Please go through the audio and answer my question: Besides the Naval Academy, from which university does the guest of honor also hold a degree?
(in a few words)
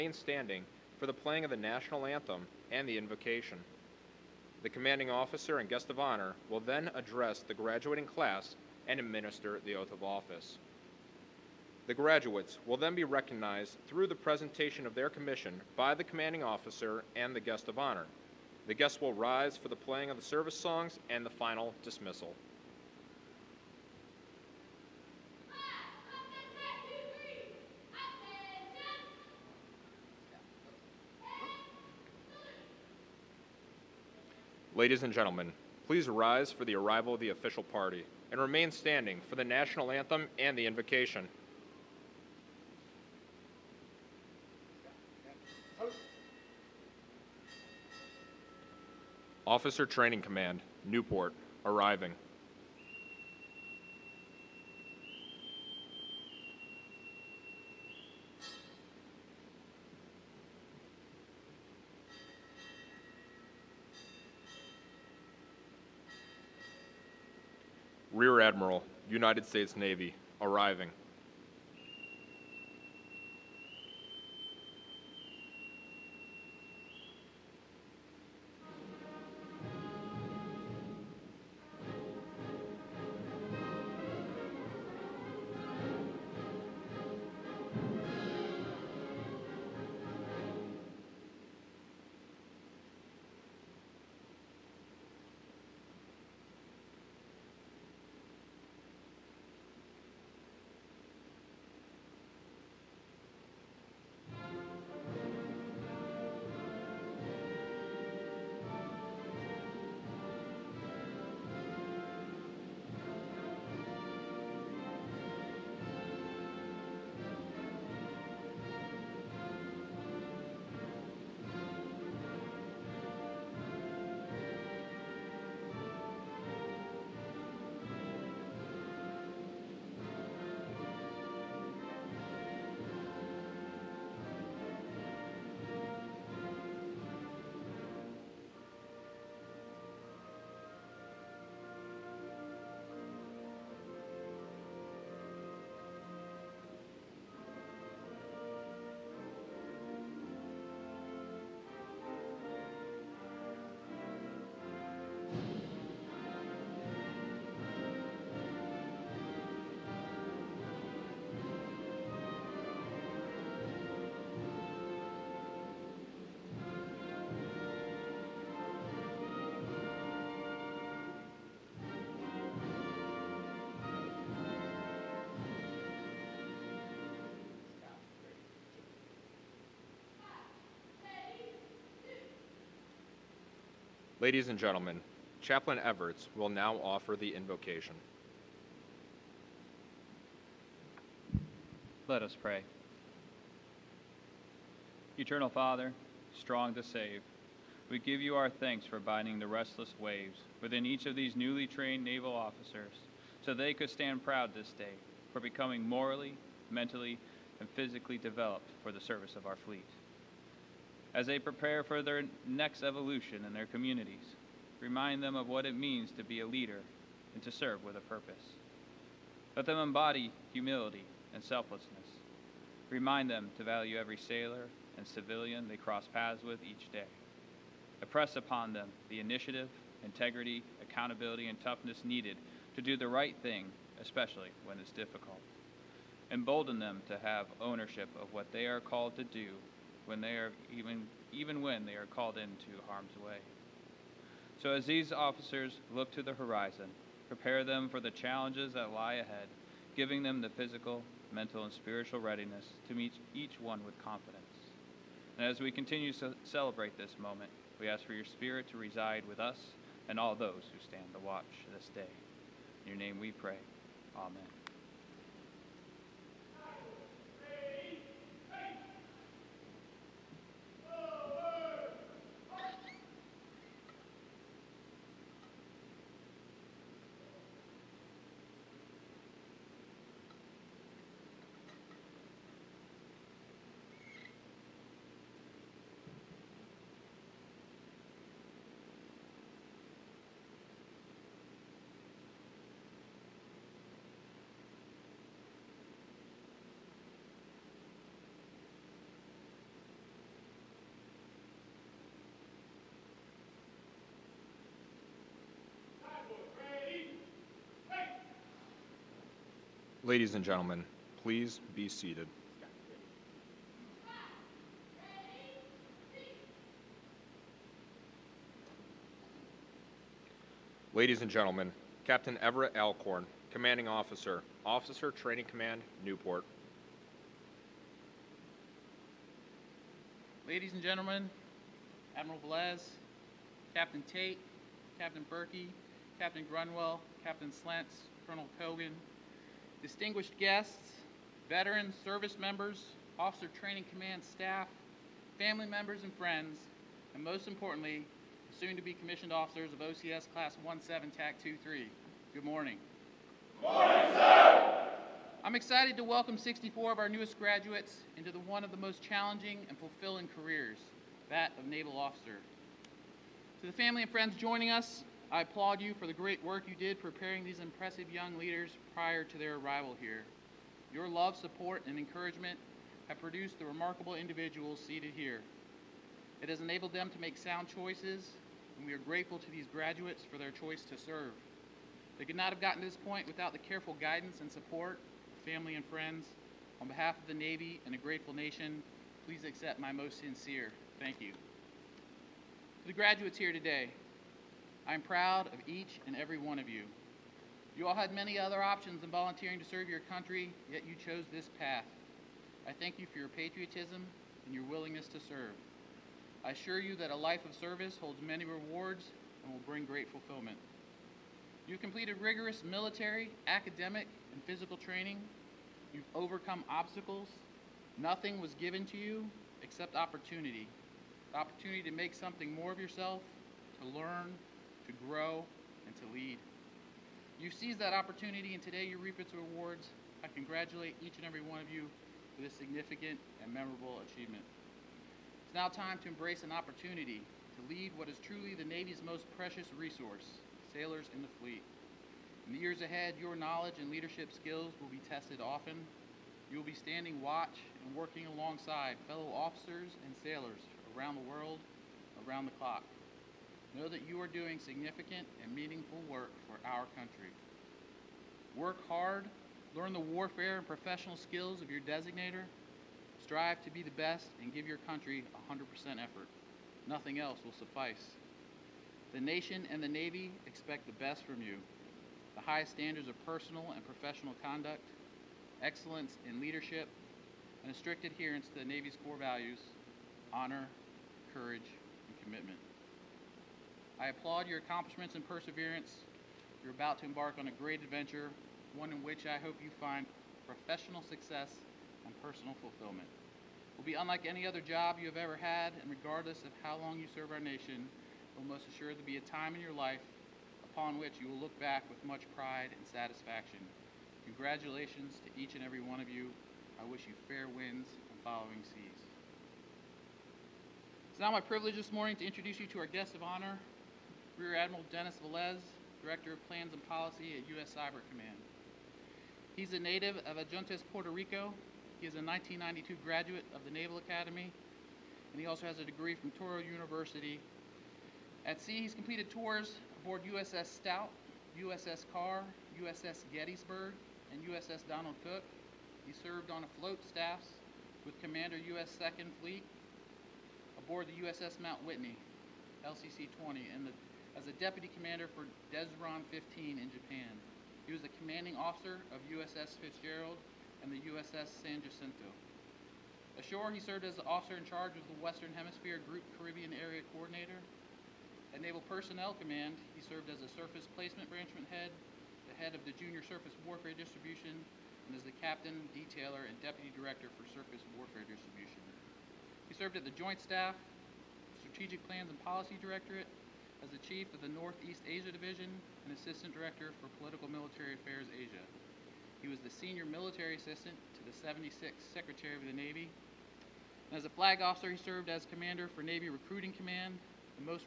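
Touro University.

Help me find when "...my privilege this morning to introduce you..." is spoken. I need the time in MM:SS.
08:31.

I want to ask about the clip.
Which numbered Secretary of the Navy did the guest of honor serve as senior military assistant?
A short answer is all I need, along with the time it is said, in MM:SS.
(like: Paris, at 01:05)
76th, at 09:41.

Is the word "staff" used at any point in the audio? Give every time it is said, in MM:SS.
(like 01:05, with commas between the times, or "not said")
05:44, 08:57, 09:30.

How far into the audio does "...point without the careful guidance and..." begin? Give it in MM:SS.
06:22.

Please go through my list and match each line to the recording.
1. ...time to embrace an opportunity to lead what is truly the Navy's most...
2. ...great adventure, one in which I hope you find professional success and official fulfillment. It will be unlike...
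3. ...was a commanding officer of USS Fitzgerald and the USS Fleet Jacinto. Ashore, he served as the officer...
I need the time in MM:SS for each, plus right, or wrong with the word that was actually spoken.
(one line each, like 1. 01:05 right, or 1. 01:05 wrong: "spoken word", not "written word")
1. 07:15 right
2. 08:07 wrong: "personal", not "official"
3. 09:07 wrong: "San", not "Fleet".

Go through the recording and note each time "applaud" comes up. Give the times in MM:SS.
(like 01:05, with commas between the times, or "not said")
06:05, 08:04.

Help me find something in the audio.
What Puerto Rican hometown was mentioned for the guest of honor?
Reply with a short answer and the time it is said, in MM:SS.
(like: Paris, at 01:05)
Adjuntas, at 08:40.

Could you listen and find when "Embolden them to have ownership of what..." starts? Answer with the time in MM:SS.
03:56.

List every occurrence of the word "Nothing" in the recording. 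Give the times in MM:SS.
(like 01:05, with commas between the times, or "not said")
06:57, 07:46.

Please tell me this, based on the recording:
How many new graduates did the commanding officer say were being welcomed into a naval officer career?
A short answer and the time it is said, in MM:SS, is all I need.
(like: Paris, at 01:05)
64, at 05:56.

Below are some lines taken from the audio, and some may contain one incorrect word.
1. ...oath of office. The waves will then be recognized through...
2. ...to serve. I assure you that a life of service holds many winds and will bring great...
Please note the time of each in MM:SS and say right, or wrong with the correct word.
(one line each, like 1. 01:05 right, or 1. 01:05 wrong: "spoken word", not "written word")
1. 00:09 wrong: "graduates", not "waves"
2. 06:45 wrong: "rewards", not "winds".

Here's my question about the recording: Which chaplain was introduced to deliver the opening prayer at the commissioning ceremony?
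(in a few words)
Chaplain Everts.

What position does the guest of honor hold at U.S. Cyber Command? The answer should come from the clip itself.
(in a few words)
Director of Plans and Policy.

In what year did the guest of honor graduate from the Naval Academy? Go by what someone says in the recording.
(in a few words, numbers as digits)
1992.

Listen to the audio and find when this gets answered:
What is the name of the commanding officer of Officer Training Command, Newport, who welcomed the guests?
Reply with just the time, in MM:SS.
05:22.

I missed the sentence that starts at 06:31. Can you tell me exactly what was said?
To the graduates here today, I'm proud of each and every one of you.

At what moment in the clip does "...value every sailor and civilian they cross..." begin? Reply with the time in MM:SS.
03:43.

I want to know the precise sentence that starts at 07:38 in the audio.
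Work hard, learn the warfare and professional skills of your designator, strive to be the best, and give your country 100% effort.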